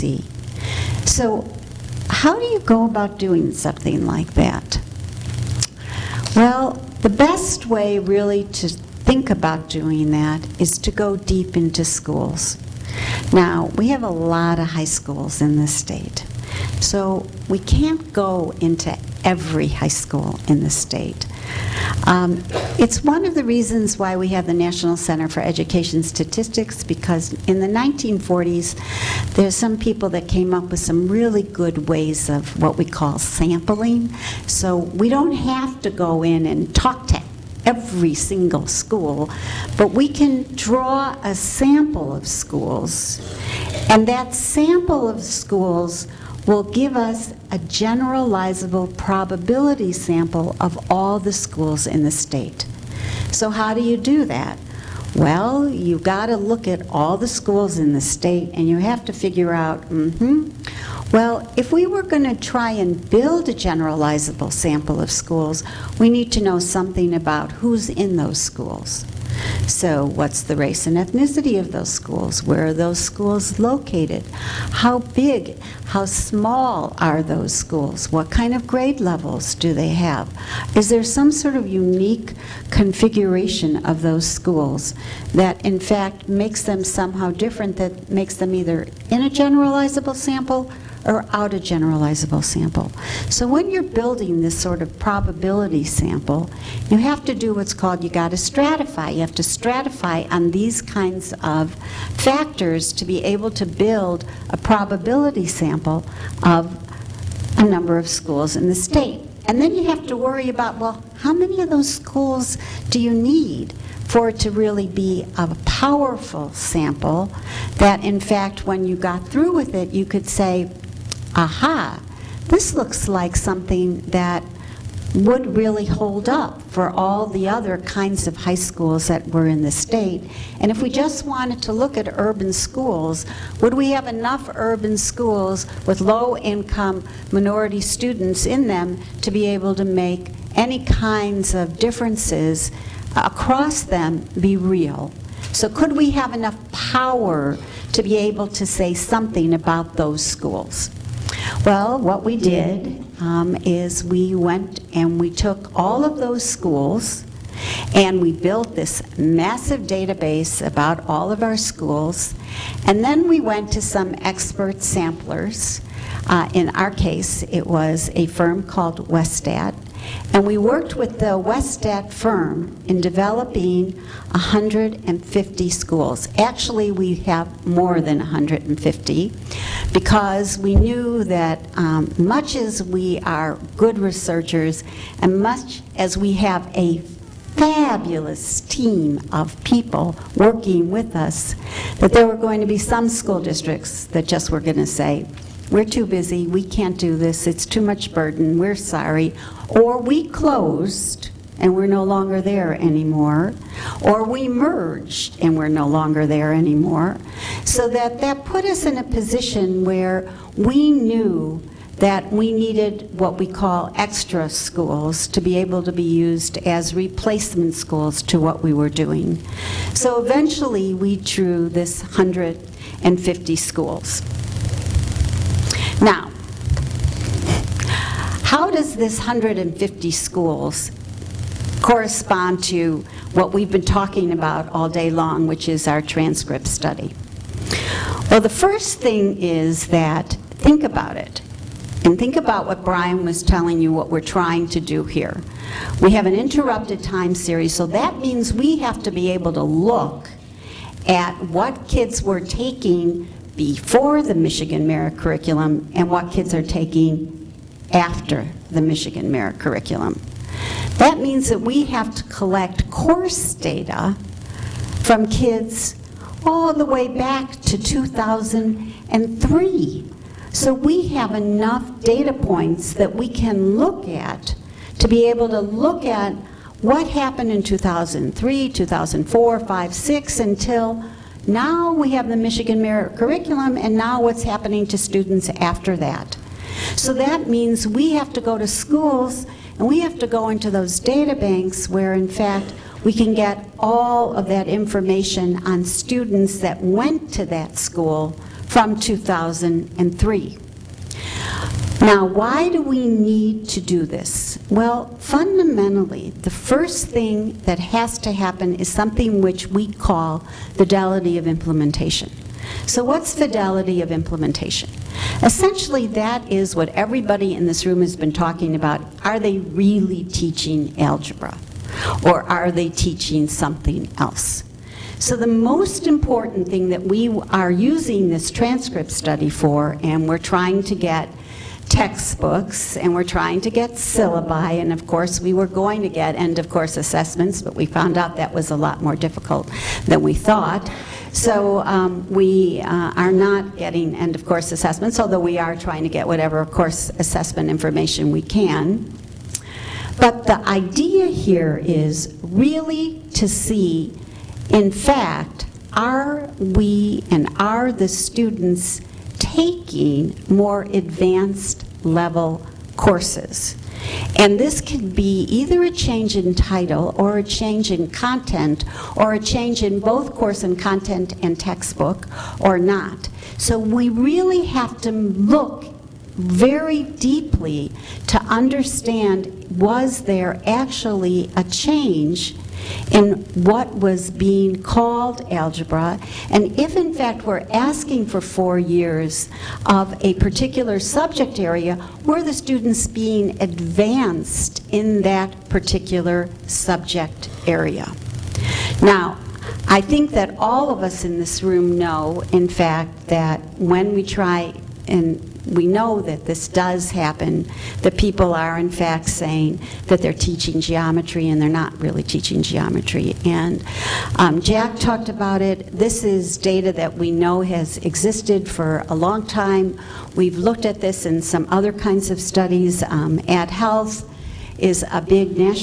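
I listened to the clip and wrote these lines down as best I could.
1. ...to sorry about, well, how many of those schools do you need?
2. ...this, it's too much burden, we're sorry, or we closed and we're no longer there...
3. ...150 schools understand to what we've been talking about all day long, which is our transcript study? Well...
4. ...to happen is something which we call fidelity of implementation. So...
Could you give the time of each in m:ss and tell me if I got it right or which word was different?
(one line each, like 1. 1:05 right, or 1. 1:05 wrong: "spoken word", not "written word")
1. 1:50 wrong: "worry", not "sorry"
2. 3:17 right
3. 3:49 wrong: "correspond", not "understand"
4. 5:08 right.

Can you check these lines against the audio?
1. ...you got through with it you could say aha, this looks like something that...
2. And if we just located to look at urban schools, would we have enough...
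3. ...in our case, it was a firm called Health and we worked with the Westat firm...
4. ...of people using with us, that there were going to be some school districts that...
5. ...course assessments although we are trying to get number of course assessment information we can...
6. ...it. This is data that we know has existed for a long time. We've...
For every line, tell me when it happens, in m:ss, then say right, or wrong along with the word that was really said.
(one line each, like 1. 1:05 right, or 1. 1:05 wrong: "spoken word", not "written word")
1. 1:58 right
2. 2:10 wrong: "wanted", not "located"
3. 2:46 wrong: "Westat", not "Health"
4. 3:09 wrong: "working", not "using"
5. 5:44 wrong: "whatever", not "number"
6. 6:55 right.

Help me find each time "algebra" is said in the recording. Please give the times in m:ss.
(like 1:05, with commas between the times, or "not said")
5:21, 6:25.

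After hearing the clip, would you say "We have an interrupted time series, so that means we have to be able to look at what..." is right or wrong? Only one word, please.
right.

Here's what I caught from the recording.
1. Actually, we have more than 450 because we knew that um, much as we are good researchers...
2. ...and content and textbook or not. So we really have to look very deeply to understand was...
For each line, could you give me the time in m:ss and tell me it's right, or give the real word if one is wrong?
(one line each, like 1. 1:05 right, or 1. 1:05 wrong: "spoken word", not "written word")
1. 2:56 wrong: "150", not "450"
2. 6:10 right.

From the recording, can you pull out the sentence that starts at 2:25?
So could we have enough power to be able to say something about those schools?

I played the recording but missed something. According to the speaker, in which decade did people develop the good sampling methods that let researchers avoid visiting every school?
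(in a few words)
1940s.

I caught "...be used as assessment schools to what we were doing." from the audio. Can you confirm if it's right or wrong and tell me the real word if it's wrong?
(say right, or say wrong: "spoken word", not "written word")
wrong: "replacement", not "assessment".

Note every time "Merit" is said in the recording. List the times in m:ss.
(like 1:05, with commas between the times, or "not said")
4:14, 4:19, 4:42.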